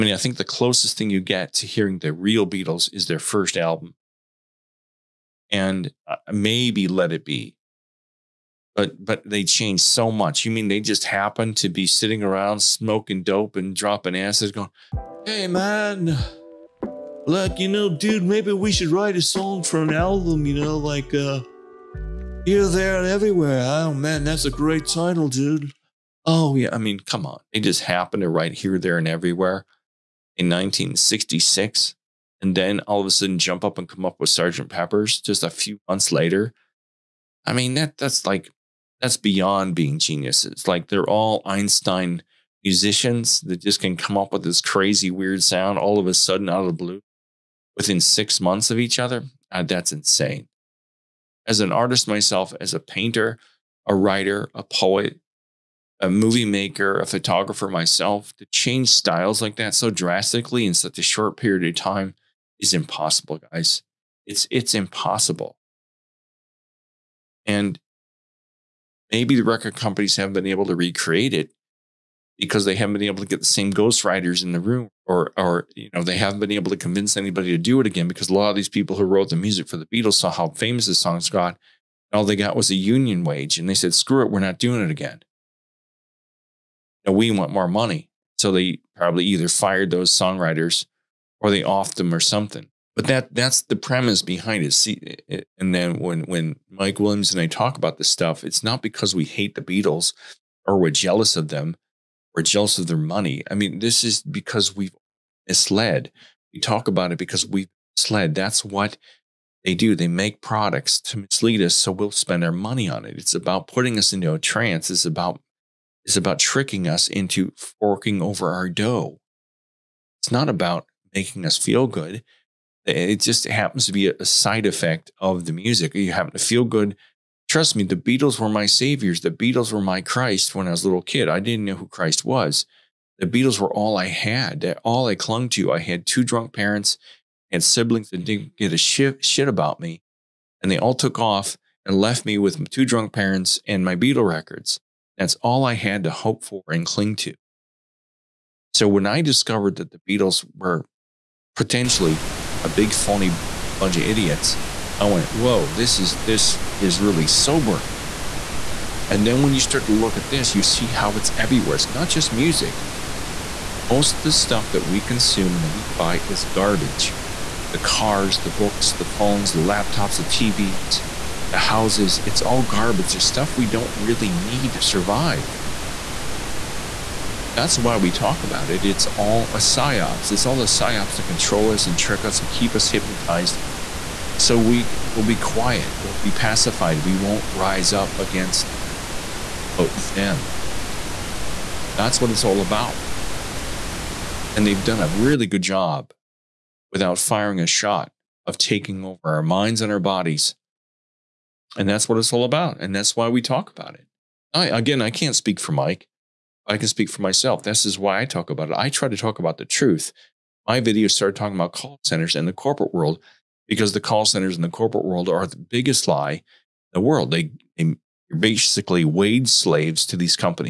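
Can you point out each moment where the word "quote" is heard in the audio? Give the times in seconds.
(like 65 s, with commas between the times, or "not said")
189 s.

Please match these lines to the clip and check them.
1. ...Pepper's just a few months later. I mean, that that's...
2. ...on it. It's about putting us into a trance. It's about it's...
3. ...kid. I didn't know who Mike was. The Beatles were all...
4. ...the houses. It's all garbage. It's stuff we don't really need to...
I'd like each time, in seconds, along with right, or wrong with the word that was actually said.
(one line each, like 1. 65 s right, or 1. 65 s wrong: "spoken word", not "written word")
1. 34 s right
2. 112 s right
3. 131 s wrong: "Christ", not "Mike"
4. 171 s right.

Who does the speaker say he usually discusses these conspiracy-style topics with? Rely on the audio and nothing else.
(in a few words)
Mike Williams.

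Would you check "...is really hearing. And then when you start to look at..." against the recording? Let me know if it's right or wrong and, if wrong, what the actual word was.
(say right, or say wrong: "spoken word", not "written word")
wrong: "sobering", not "hearing".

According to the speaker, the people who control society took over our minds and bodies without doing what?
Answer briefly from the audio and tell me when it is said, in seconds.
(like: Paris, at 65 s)
firing a shot, at 197 s.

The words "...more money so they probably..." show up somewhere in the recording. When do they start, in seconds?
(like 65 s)
87 s.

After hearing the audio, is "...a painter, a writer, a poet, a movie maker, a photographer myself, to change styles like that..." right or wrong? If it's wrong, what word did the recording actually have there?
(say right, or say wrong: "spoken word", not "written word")
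right.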